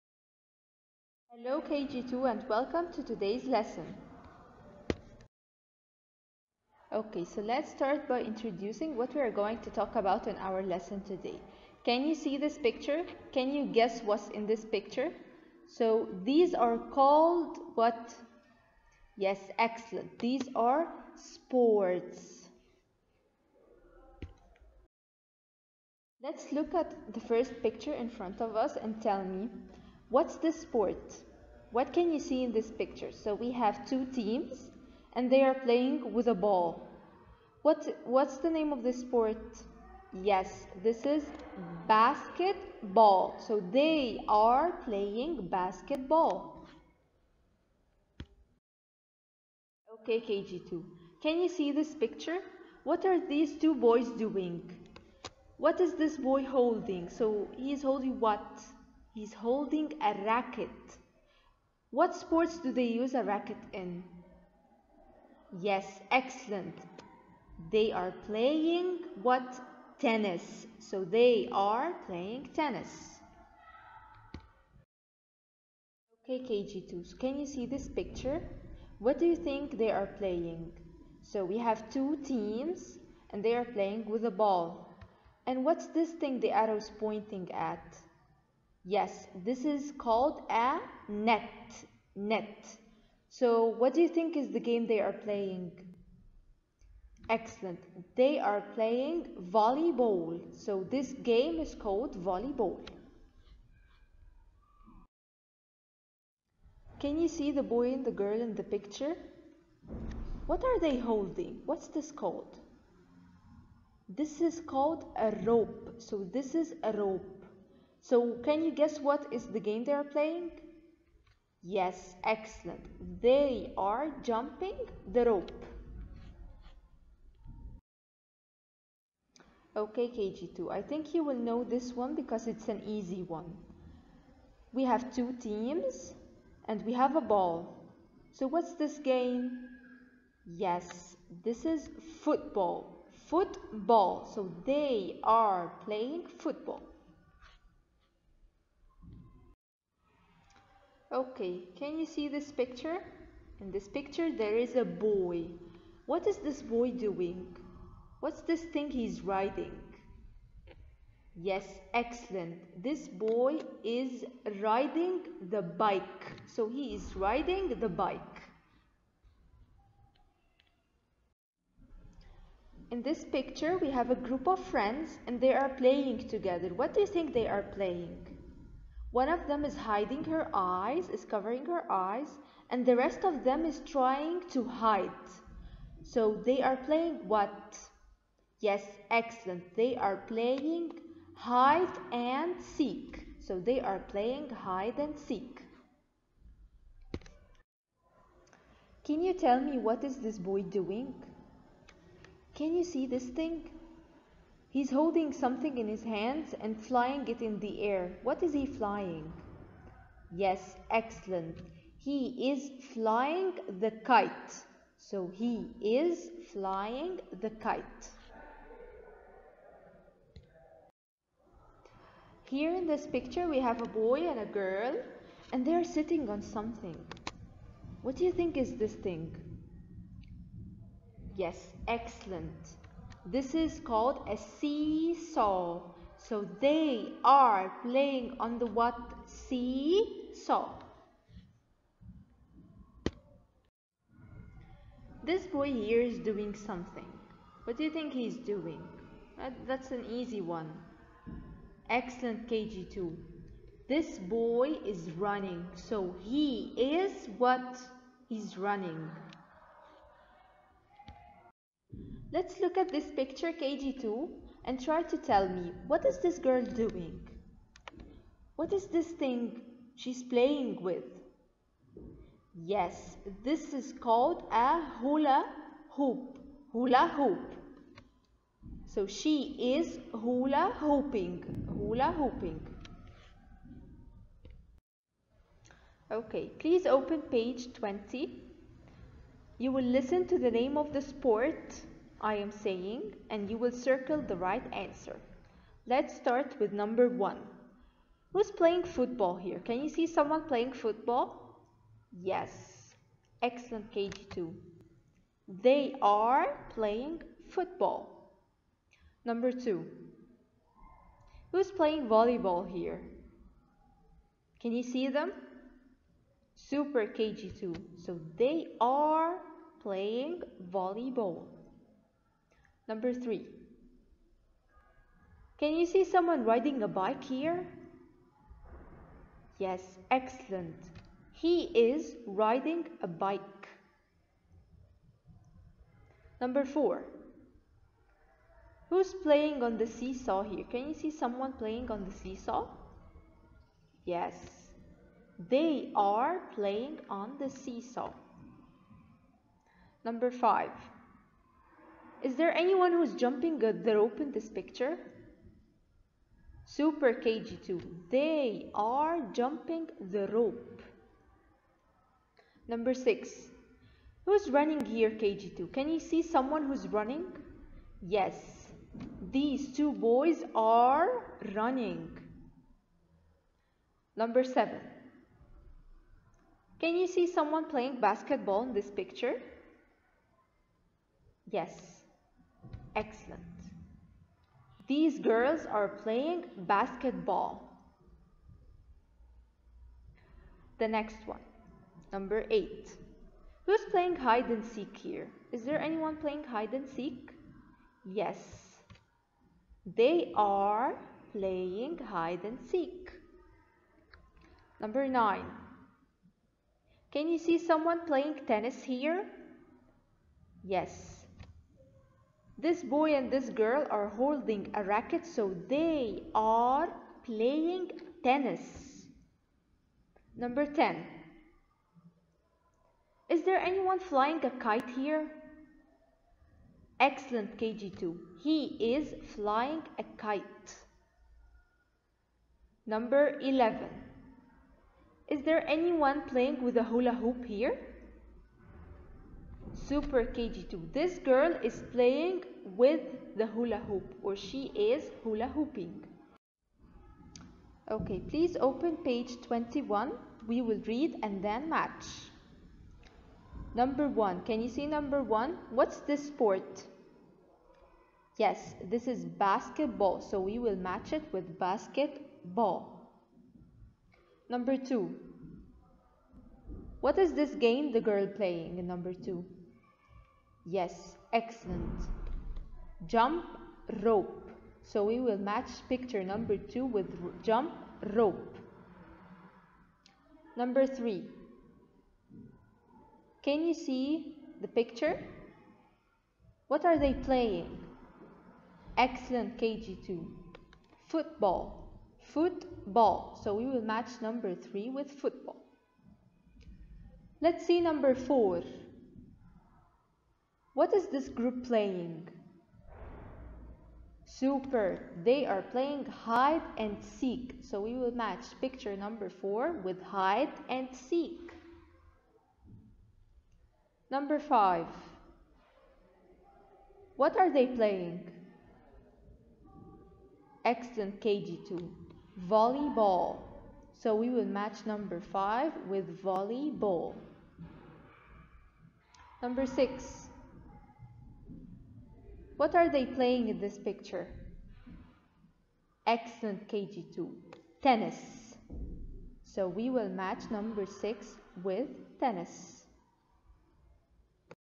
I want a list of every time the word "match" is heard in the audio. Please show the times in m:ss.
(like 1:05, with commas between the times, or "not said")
7:31, 7:40, 7:55, 8:13, 8:28, 8:44, 9:00.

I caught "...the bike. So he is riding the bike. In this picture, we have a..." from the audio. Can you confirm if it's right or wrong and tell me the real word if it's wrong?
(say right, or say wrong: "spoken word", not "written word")
right.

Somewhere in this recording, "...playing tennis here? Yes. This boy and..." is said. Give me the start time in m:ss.
6:48.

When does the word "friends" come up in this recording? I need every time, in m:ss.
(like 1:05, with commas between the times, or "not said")
2:54.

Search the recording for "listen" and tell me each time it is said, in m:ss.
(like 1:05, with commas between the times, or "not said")
4:49.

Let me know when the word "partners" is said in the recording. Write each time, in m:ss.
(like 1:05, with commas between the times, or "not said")
not said.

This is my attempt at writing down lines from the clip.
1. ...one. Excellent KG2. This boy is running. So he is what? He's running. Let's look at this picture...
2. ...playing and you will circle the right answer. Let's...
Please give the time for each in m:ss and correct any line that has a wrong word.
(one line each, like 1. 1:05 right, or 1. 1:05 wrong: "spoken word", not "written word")
1. 4:10 right
2. 4:52 wrong: "saying", not "playing".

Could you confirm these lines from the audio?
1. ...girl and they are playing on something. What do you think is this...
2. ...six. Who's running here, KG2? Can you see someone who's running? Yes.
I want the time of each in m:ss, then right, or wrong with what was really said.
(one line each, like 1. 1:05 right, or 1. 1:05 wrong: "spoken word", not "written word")
1. 3:44 wrong: "sitting", not "playing"
2. 6:02 right.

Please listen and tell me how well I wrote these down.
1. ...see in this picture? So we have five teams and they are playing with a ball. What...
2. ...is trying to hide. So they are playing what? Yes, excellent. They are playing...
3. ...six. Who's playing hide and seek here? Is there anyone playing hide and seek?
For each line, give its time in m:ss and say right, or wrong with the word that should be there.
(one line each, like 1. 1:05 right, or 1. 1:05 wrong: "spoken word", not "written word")
1. 0:32 wrong: "two", not "five"
2. 3:03 right
3. 6:32 wrong: "eight", not "six".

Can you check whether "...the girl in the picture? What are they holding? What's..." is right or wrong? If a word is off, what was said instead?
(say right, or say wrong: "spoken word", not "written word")
right.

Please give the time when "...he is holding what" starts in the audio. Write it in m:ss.
0:57.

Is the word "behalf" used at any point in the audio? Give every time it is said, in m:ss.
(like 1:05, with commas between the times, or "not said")
not said.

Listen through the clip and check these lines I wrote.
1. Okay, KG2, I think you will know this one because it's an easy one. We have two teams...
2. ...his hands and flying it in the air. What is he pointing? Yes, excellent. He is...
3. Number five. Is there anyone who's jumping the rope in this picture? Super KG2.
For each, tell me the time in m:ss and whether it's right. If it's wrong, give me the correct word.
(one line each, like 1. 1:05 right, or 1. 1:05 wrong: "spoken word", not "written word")
1. 2:09 right
2. 3:25 wrong: "flying", not "pointing"
3. 5:50 right.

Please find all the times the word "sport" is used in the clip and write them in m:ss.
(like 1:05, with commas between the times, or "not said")
0:21, 0:30, 0:38, 1:02, 4:51, 7:36.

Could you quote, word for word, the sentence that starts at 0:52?
What are these two boys doing?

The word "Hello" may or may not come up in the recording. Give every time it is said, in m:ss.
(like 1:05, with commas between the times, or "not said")
0:01.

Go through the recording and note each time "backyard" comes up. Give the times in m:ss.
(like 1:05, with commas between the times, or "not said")
not said.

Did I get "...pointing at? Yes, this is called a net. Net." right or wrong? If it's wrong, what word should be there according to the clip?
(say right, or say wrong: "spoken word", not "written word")
right.